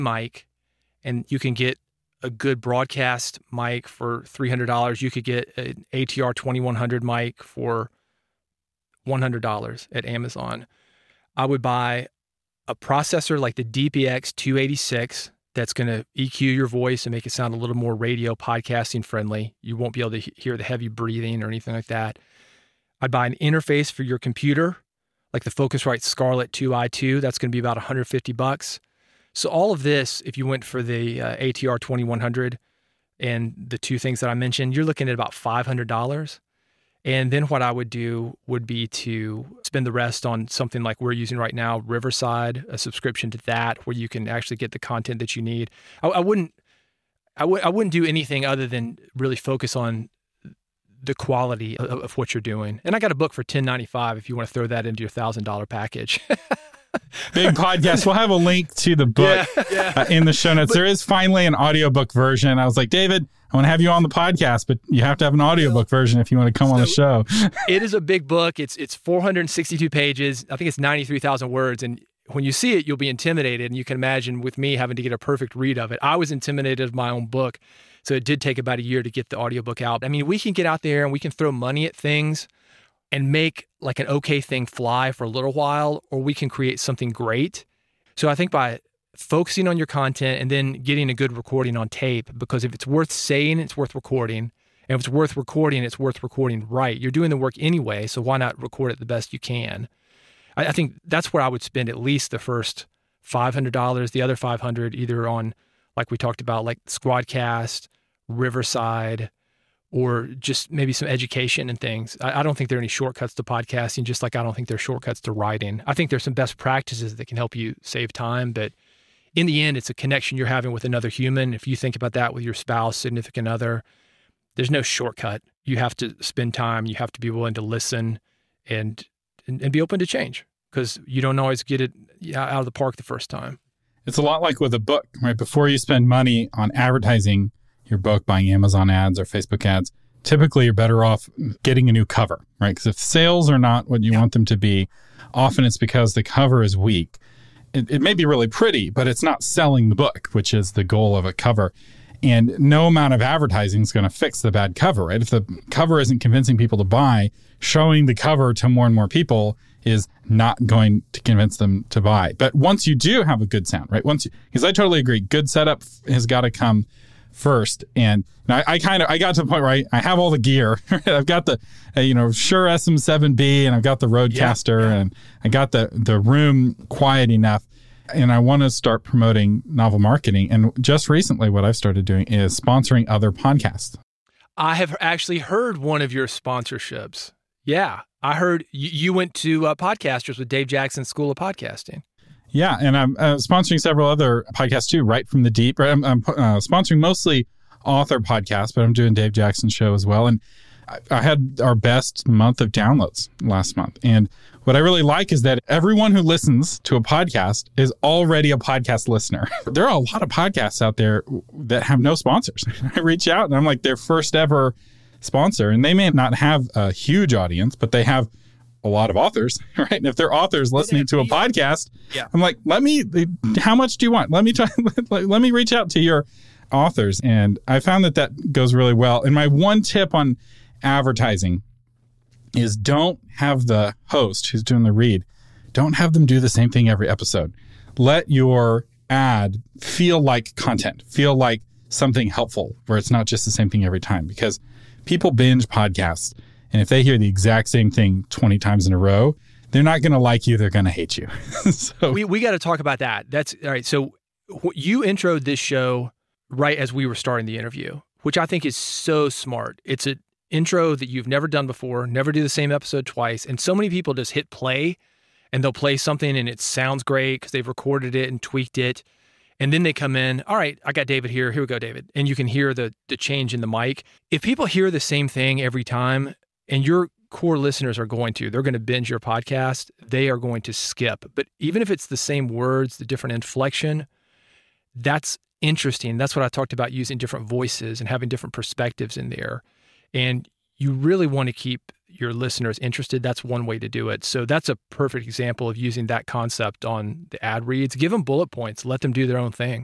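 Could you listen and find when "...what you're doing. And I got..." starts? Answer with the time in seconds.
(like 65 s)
52 s.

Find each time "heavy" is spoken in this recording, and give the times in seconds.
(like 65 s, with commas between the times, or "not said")
20 s.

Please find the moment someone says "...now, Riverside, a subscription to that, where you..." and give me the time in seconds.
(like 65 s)
41 s.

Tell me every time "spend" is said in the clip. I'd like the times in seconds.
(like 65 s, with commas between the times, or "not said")
39 s, 101 s, 126 s, 135 s.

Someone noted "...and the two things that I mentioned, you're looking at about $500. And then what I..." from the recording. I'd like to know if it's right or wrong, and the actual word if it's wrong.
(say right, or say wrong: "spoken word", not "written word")
right.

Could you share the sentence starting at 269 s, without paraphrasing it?
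And then they come in, all right, I got David here.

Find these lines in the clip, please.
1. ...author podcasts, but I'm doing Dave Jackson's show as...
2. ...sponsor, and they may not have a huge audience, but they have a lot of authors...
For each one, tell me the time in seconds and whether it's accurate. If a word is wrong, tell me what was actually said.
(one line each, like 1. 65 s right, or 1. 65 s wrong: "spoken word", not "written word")
1. 197 s right
2. 215 s right.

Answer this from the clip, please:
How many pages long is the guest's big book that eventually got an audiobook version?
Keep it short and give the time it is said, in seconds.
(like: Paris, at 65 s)
462, at 68 s.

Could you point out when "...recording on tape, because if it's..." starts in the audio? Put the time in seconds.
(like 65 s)
91 s.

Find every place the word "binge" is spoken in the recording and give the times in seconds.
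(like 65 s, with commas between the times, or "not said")
245 s, 278 s.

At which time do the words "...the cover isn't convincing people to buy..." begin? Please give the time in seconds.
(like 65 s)
155 s.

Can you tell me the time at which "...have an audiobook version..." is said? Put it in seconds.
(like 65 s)
65 s.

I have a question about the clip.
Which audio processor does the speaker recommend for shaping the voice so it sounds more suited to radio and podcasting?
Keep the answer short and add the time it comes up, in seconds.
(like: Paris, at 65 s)
dbx 286, at 13 s.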